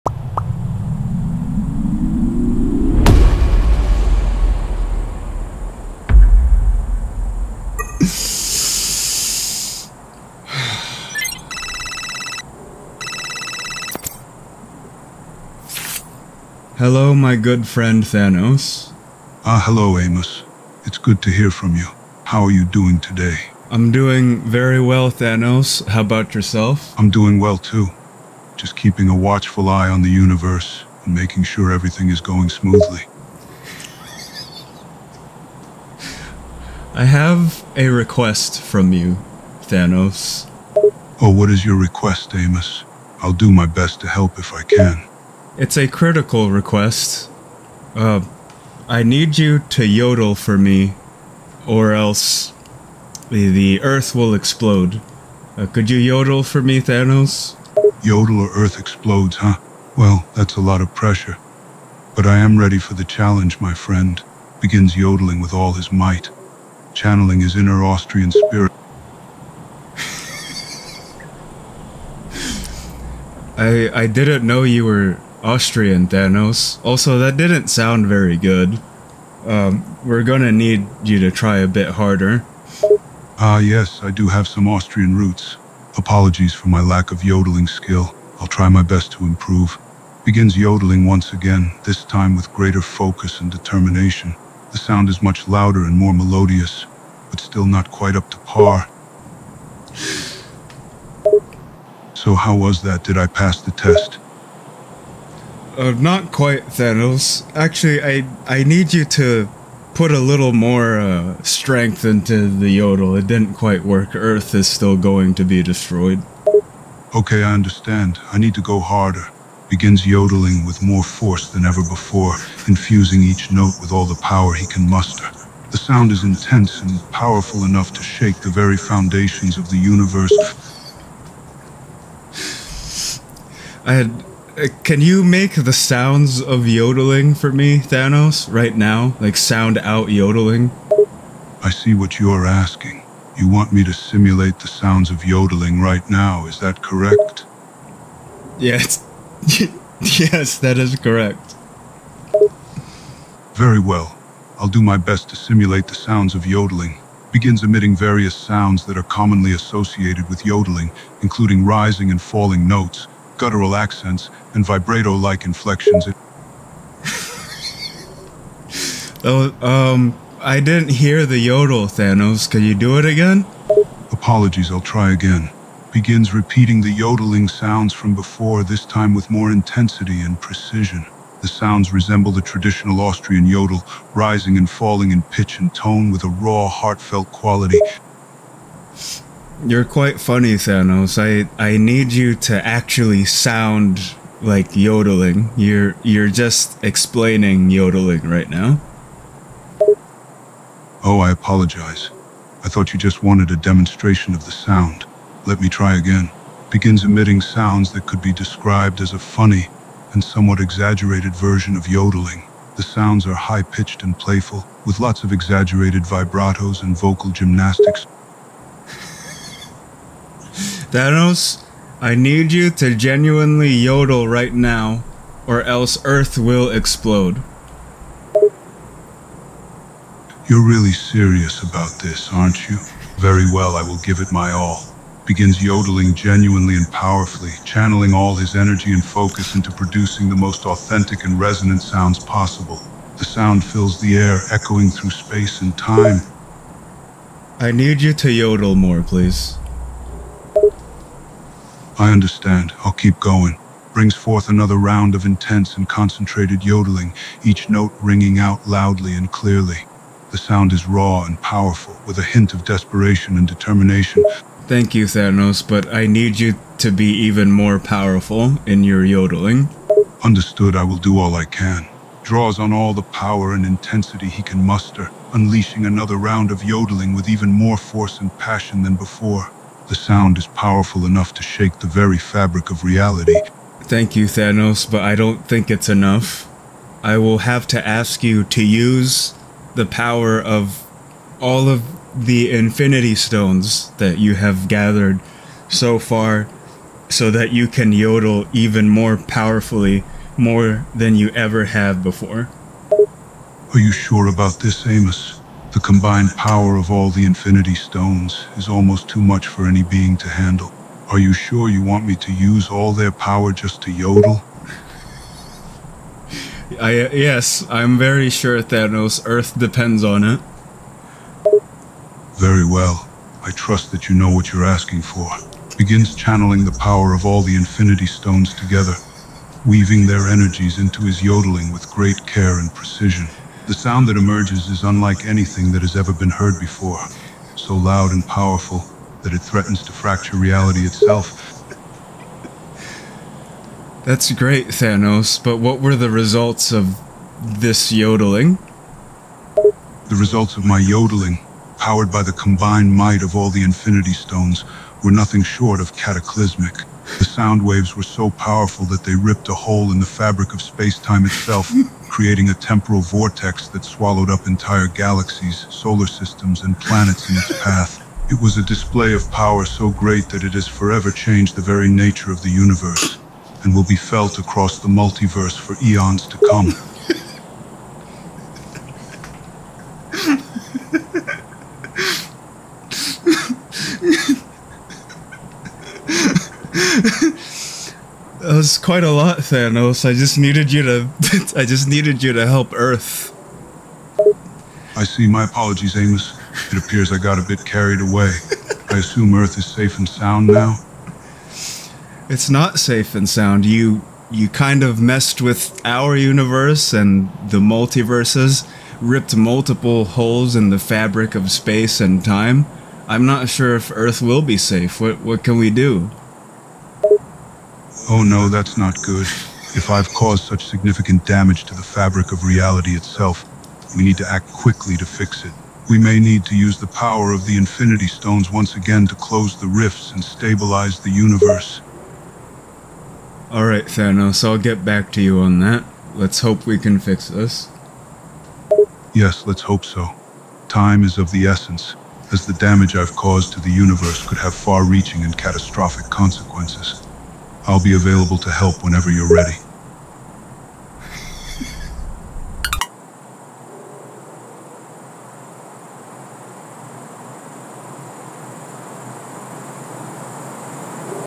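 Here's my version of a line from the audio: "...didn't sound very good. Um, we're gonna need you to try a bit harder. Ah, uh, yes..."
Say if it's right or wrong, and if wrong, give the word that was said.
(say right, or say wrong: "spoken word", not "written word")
right.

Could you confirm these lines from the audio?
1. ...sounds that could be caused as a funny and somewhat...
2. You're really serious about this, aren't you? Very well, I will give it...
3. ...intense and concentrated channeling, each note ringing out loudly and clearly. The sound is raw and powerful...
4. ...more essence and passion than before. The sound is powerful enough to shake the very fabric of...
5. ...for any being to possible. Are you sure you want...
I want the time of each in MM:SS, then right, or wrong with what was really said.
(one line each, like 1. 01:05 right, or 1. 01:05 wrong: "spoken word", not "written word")
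1. 03:27 wrong: "described", not "caused"
2. 03:50 right
3. 04:15 wrong: "yodeling", not "channeling"
4. 04:37 wrong: "force", not "essence"
5. 05:09 wrong: "handle", not "possible".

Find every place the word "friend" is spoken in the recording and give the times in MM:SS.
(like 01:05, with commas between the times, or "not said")
00:17, 01:03.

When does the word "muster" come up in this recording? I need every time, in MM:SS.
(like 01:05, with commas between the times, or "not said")
02:04, 04:34.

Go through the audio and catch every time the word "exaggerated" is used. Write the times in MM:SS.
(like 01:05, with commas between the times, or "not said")
03:30, 03:35.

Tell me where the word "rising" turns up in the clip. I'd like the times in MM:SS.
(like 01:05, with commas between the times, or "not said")
02:41, 03:04.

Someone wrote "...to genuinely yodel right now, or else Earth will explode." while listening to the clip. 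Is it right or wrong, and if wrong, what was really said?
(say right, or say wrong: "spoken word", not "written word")
right.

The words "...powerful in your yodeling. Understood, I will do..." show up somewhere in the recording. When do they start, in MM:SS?
04:27.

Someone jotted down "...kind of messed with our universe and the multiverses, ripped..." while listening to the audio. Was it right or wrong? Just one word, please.
right.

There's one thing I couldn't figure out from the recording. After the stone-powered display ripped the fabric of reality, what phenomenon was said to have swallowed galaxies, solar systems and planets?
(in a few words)
A temporal vortex.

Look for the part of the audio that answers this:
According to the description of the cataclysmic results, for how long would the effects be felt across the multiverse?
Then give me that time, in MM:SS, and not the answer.
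06:15.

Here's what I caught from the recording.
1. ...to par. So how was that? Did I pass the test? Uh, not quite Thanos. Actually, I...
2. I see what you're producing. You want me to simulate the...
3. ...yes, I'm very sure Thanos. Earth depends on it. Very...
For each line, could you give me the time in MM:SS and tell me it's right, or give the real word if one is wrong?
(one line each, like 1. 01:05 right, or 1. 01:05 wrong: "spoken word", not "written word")
1. 01:38 right
2. 02:21 wrong: "asking", not "producing"
3. 05:17 right.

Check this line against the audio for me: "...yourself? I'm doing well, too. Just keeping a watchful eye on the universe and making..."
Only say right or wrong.
right.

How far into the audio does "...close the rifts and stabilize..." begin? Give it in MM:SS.
07:09.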